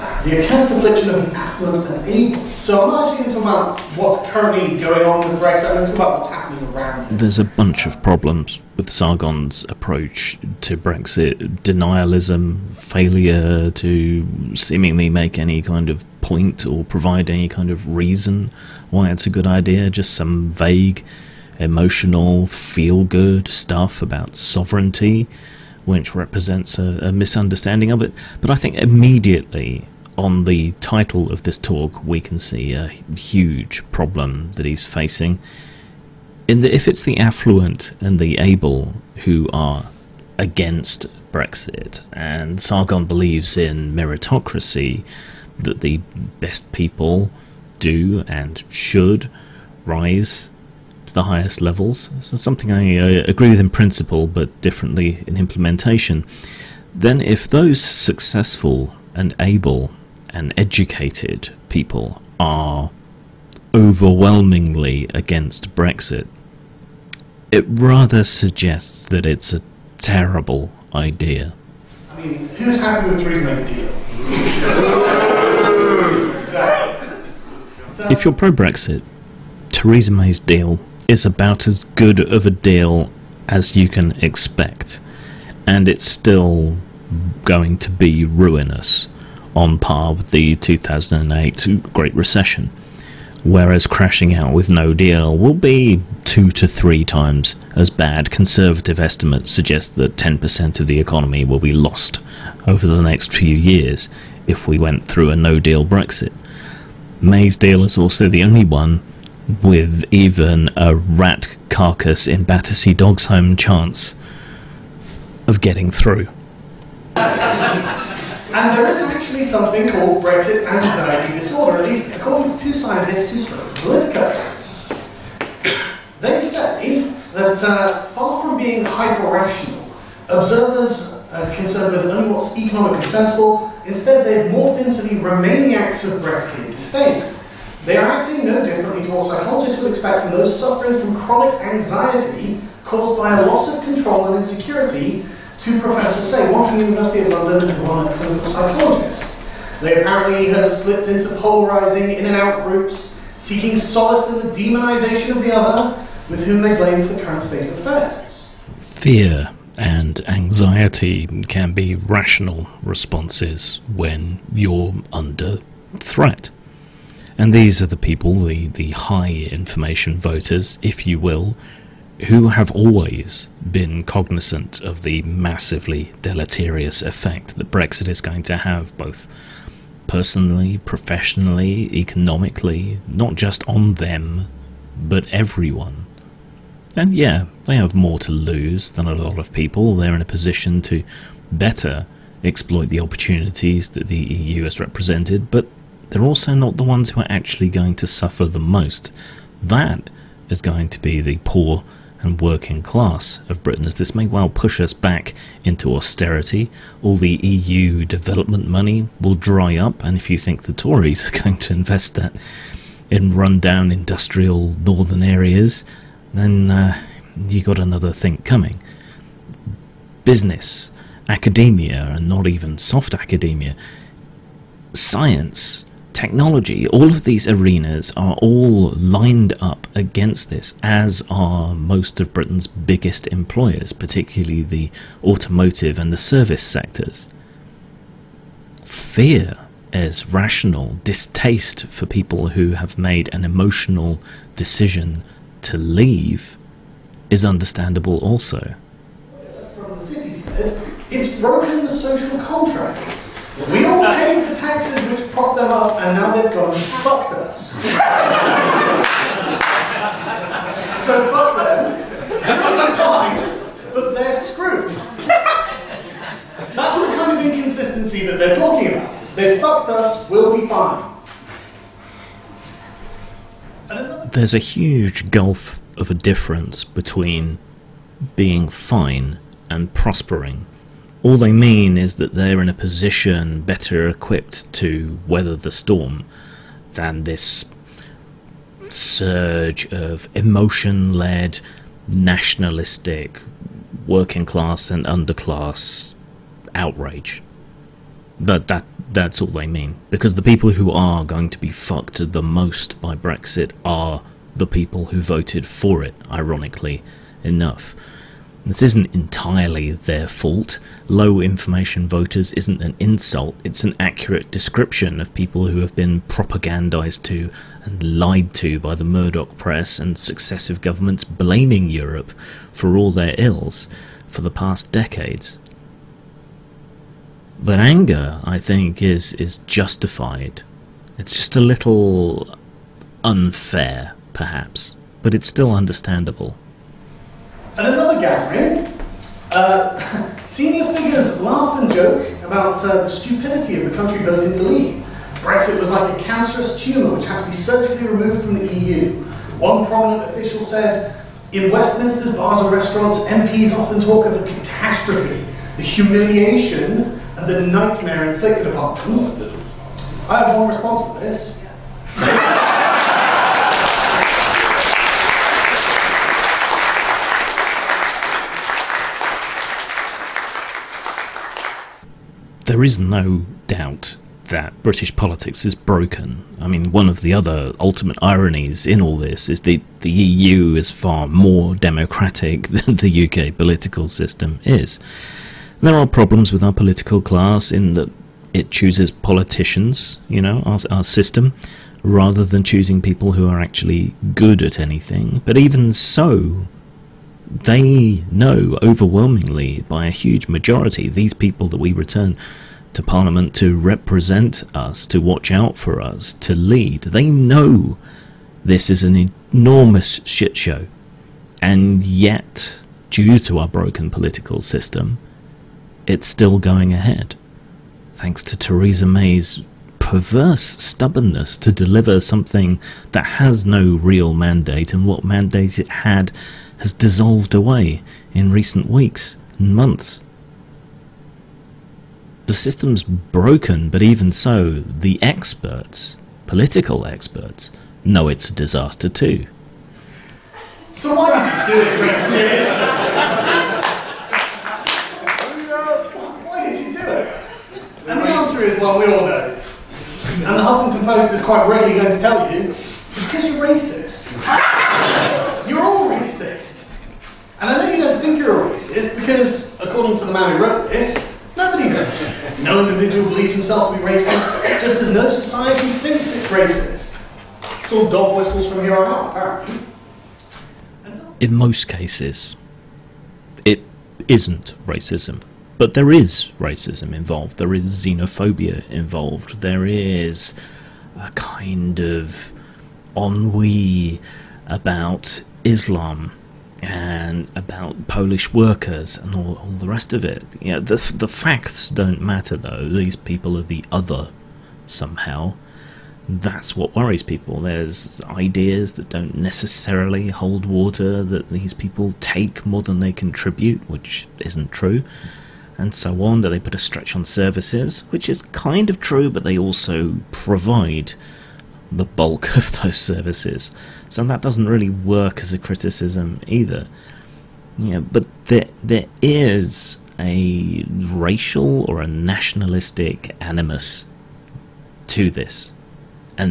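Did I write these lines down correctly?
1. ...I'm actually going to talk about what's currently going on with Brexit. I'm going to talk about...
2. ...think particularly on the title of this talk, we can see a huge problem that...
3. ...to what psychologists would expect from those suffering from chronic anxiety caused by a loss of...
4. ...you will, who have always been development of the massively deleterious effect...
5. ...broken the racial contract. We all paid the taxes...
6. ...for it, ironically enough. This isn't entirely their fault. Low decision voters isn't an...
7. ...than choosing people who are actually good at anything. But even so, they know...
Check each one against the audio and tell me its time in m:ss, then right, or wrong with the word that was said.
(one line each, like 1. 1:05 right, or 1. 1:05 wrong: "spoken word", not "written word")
1. 0:02 right
2. 0:28 wrong: "immediately", not "particularly"
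3. 2:19 right
4. 2:51 wrong: "cognizant", not "development"
5. 4:11 wrong: "social", not "racial"
6. 5:05 wrong: "information", not "decision"
7. 6:32 right.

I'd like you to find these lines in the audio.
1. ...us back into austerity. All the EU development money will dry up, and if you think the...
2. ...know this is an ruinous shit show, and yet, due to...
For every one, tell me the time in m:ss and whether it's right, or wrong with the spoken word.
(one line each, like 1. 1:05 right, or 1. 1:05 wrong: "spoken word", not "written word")
1. 3:24 right
2. 6:47 wrong: "enormous", not "ruinous".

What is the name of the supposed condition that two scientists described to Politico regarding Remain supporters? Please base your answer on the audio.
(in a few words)
Brexit anxiety disorder.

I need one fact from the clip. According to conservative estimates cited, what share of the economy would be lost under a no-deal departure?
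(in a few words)
10%.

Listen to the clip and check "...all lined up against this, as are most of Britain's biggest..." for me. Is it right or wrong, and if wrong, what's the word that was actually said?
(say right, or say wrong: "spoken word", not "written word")
right.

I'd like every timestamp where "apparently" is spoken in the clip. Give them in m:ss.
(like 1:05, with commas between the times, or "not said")
2:29, 7:49.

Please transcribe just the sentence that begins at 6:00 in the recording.
I have one response to this.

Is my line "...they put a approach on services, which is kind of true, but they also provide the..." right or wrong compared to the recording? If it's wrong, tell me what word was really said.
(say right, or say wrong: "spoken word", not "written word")
wrong: "stretch", not "approach".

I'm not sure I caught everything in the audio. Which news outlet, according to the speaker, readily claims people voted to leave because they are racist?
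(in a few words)
Huffington Post.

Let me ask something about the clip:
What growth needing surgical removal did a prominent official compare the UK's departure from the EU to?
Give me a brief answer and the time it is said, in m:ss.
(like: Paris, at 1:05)
cancerous tumour, at 5:46.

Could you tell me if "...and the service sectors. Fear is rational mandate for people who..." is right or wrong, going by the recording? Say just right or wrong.
wrong.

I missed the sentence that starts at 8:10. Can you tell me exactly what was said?
You know, the, the facts don't matter though, these people are the other somehow.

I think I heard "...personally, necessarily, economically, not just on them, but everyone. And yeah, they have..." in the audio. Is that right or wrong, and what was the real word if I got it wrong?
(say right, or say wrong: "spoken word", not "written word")
wrong: "professionally", not "necessarily".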